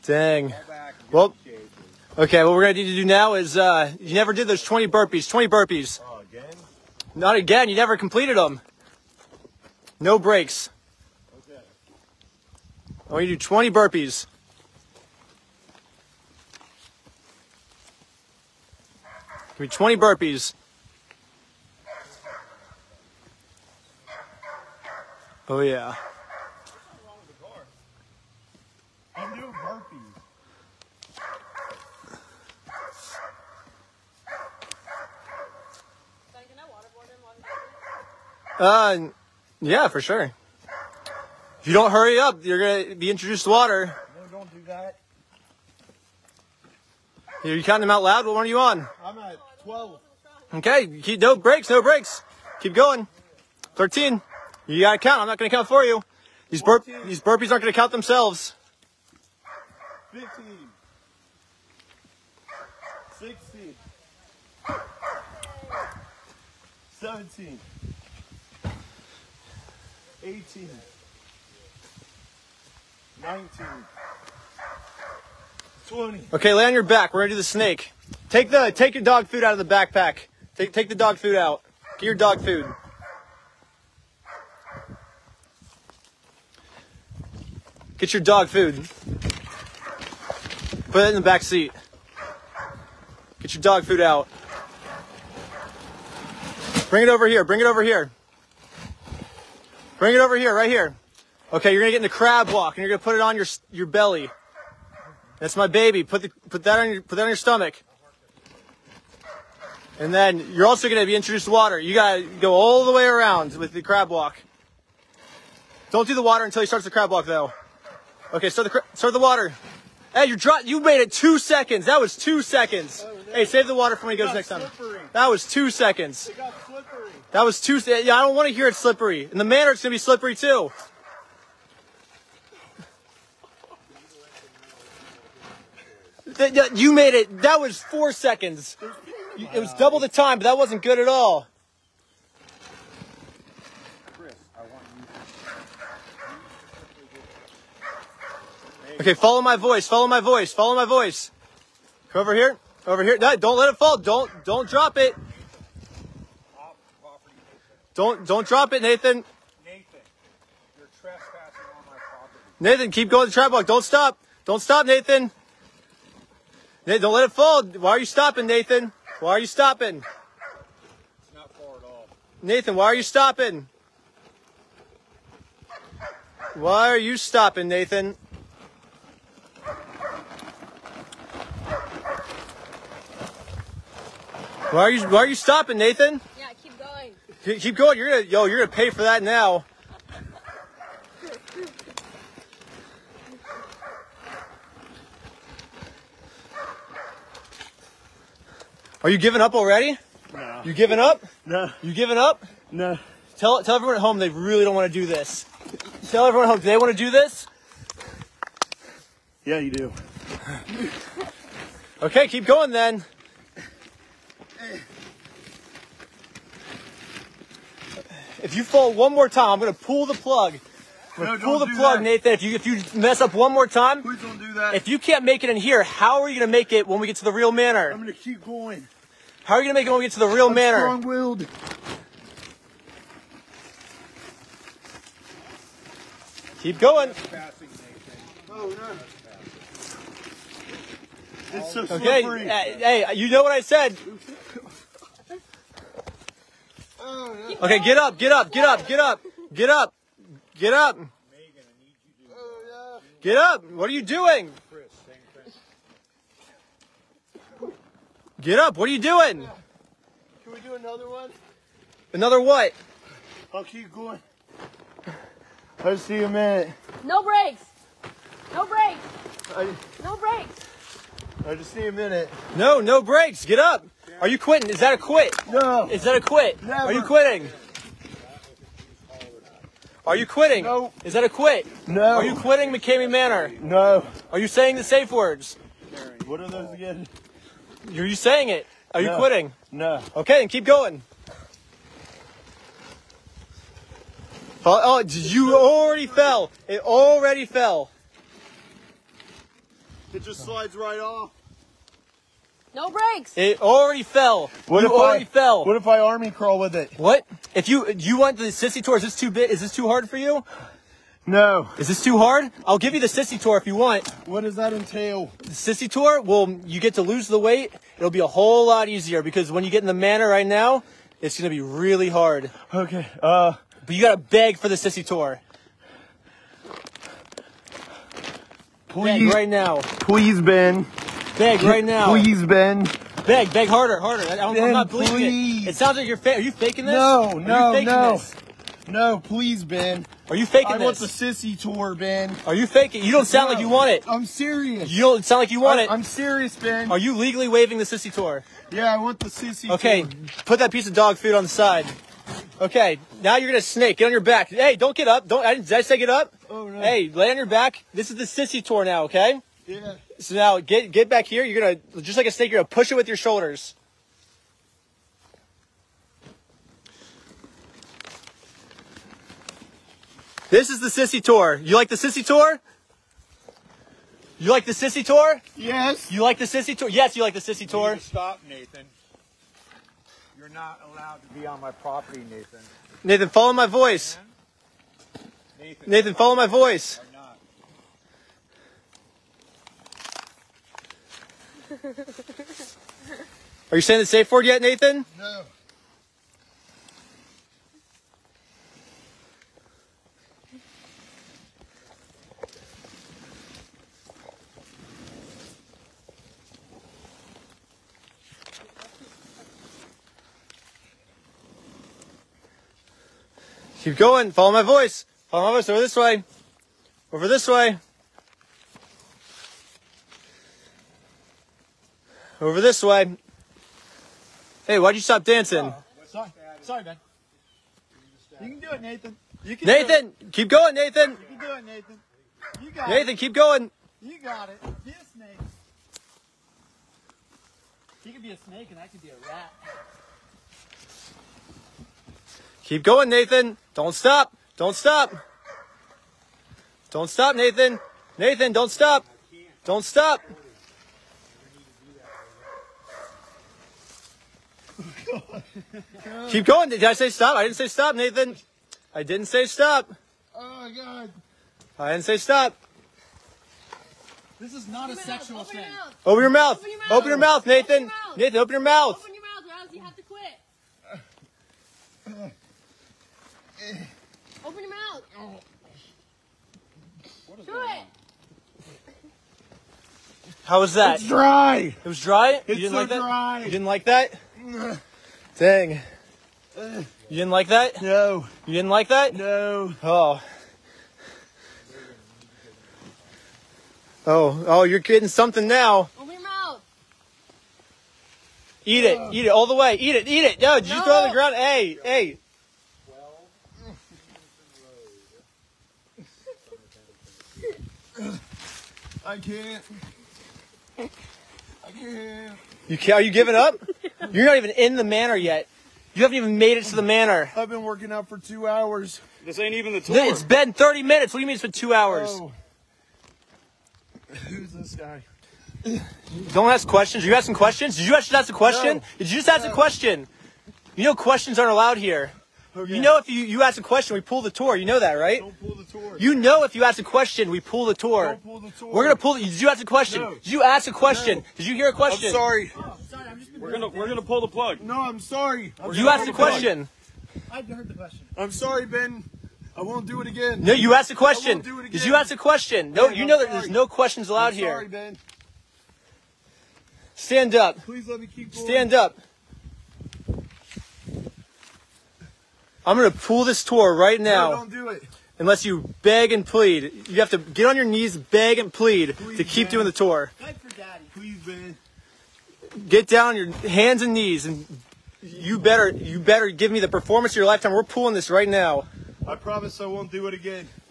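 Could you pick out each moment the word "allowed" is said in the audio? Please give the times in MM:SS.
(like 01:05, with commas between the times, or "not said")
06:20, 08:51, 09:14.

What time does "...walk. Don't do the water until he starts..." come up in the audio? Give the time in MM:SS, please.
01:54.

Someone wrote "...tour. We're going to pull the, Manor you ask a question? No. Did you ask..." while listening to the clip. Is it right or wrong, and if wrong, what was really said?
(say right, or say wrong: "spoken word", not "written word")
wrong: "Did", not "Manor".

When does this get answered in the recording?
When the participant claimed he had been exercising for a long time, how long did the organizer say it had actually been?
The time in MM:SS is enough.
08:40.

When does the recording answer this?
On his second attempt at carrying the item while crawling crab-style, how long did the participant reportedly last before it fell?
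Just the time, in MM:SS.
02:17.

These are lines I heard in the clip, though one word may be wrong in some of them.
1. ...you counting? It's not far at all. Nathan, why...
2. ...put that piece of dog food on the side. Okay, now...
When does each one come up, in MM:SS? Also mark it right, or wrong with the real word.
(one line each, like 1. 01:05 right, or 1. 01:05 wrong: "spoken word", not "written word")
1. 02:49 wrong: "stopping", not "counting"
2. 05:50 right.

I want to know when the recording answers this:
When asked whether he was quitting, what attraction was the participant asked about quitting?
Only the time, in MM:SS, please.
04:42.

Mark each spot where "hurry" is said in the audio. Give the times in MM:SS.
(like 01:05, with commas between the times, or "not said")
00:41.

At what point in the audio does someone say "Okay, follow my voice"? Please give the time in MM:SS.
02:28.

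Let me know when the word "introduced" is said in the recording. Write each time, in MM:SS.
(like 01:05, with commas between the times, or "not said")
00:43, 01:51.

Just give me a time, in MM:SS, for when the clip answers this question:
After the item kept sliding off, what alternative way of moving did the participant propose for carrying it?
05:05.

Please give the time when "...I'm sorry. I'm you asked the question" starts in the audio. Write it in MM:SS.
09:04.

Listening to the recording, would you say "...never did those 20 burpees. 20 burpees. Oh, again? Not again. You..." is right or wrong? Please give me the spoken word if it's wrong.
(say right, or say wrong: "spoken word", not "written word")
right.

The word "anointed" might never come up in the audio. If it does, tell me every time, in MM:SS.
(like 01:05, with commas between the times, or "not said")
not said.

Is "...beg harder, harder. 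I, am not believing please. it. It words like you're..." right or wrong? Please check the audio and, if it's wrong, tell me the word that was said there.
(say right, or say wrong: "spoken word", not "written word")
wrong: "sounds", not "words".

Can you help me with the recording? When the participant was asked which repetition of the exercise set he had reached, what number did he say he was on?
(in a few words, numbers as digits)
12.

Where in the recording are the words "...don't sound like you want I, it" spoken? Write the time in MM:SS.
05:45.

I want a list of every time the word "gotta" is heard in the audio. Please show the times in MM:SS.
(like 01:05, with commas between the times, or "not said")
00:54, 01:51, 05:24.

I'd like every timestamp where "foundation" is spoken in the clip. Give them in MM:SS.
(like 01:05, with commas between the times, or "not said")
not said.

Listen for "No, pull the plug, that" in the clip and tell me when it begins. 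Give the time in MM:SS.
03:41.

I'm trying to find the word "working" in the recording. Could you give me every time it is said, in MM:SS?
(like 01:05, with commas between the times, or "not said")
08:37.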